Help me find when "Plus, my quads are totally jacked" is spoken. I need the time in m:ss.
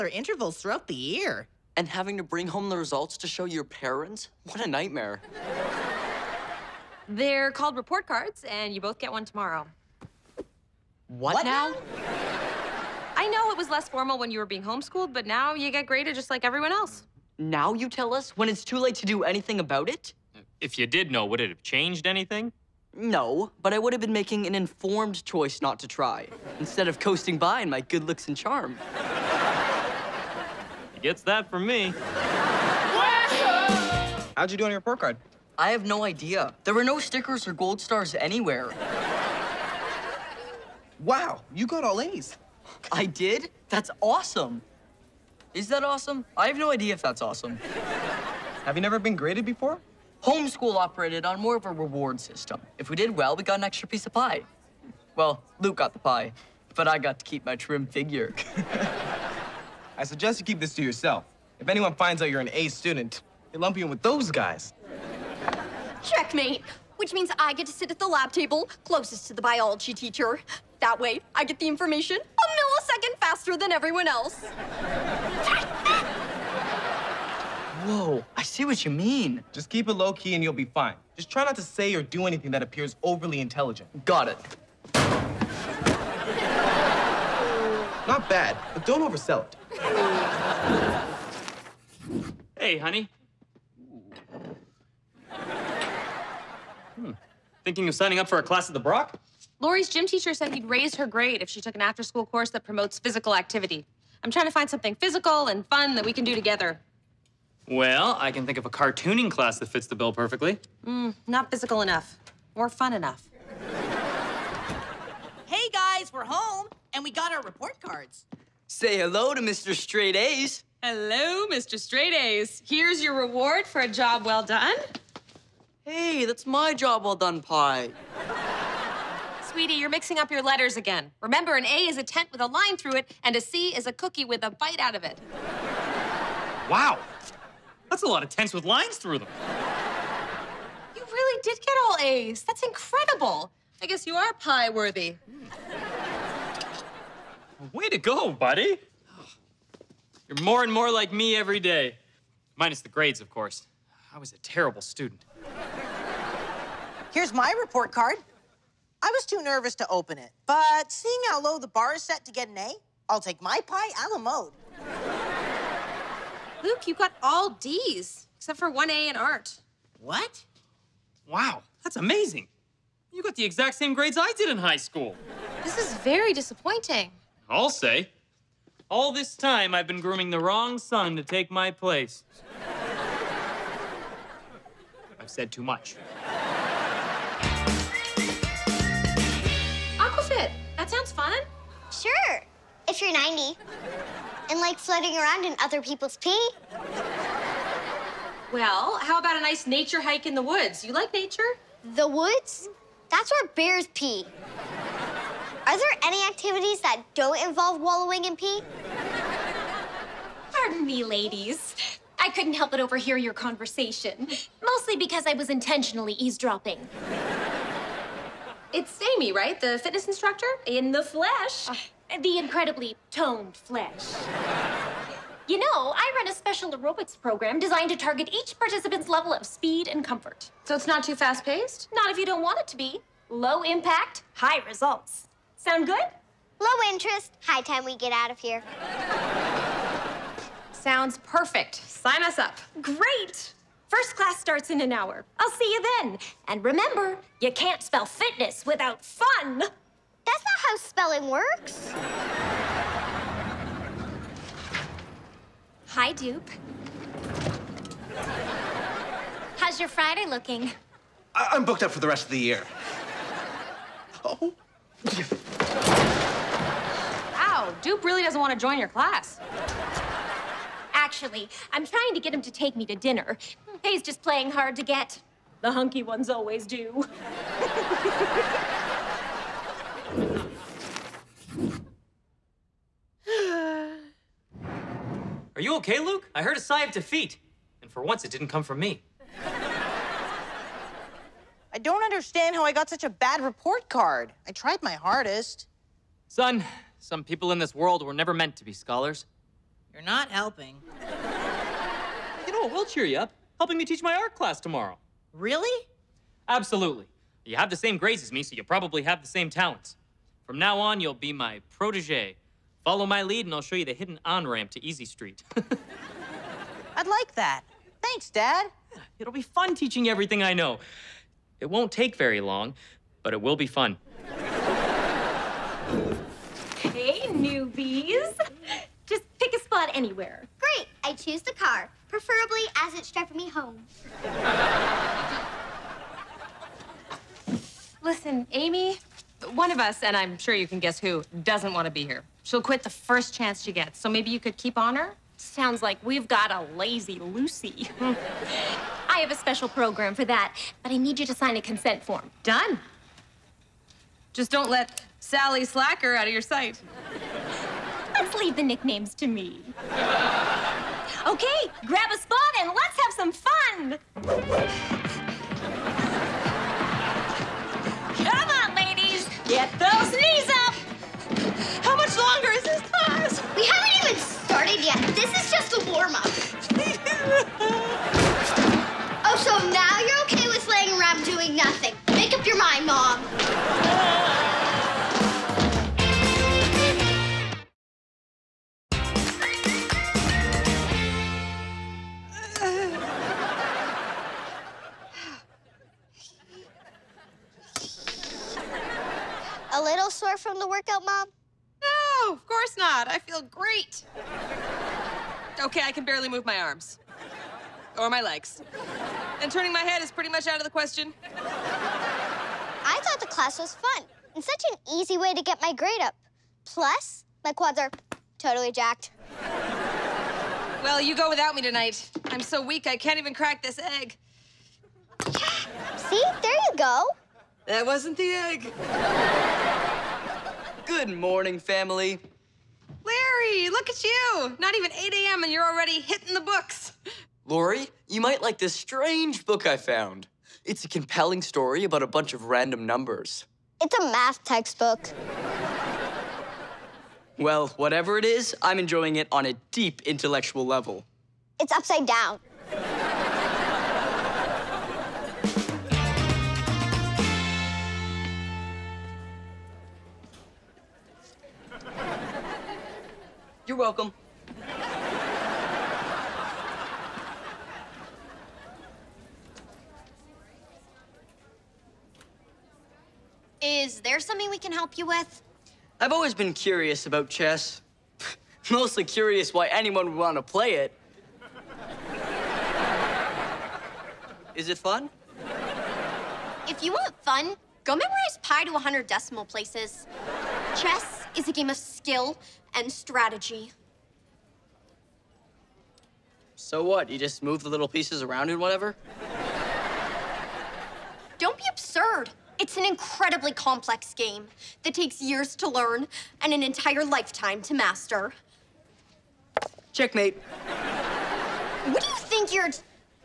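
6:56.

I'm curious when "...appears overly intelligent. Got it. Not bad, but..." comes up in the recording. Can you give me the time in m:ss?
1:22.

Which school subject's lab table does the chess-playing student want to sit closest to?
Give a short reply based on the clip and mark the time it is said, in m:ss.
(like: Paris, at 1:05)
biology, at 1:09.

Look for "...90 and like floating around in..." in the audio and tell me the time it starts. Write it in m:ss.
3:13.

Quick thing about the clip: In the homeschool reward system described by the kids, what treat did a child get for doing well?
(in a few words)
an extra piece of pie.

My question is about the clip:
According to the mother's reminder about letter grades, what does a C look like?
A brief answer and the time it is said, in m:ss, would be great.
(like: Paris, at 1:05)
a cookie with a bite out of it, at 2:13.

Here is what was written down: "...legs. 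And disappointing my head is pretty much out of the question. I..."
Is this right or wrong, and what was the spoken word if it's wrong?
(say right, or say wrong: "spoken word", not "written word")
wrong: "turning", not "disappointing".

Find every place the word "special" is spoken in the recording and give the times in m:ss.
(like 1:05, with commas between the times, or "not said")
3:46, 5:49.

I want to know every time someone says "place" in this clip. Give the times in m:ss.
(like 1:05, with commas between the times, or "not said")
3:01, 8:09.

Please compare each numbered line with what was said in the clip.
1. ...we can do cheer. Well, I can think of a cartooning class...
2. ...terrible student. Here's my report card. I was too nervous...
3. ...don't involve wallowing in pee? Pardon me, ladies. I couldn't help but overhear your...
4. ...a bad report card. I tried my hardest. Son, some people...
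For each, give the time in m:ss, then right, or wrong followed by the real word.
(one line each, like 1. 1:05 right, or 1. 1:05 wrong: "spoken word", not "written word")
1. 1:46 wrong: "together", not "cheer"
2. 2:34 right
3. 3:27 right
4. 4:53 right.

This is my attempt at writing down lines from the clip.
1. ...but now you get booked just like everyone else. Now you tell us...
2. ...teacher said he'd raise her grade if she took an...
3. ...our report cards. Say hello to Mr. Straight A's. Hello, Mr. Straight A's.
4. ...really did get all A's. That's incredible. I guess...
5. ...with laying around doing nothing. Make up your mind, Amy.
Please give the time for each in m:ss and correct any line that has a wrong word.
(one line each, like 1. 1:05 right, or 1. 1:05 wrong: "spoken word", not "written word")
1. 0:15 wrong: "graded", not "booked"
2. 1:40 right
3. 1:57 right
4. 2:21 right
5. 6:20 wrong: "Mom", not "Amy".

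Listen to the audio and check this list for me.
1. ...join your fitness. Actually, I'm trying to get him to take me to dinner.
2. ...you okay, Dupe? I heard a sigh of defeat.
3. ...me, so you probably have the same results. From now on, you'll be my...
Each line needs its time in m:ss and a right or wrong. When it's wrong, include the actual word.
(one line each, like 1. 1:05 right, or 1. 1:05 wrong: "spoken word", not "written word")
1. 4:28 wrong: "class", not "fitness"
2. 4:45 wrong: "Luke", not "Dupe"
3. 5:08 wrong: "talents", not "results".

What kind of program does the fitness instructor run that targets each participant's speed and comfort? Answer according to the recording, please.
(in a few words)
aerobics.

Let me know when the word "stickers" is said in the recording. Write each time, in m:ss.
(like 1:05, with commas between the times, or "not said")
0:36.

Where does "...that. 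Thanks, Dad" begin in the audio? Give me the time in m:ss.
5:17.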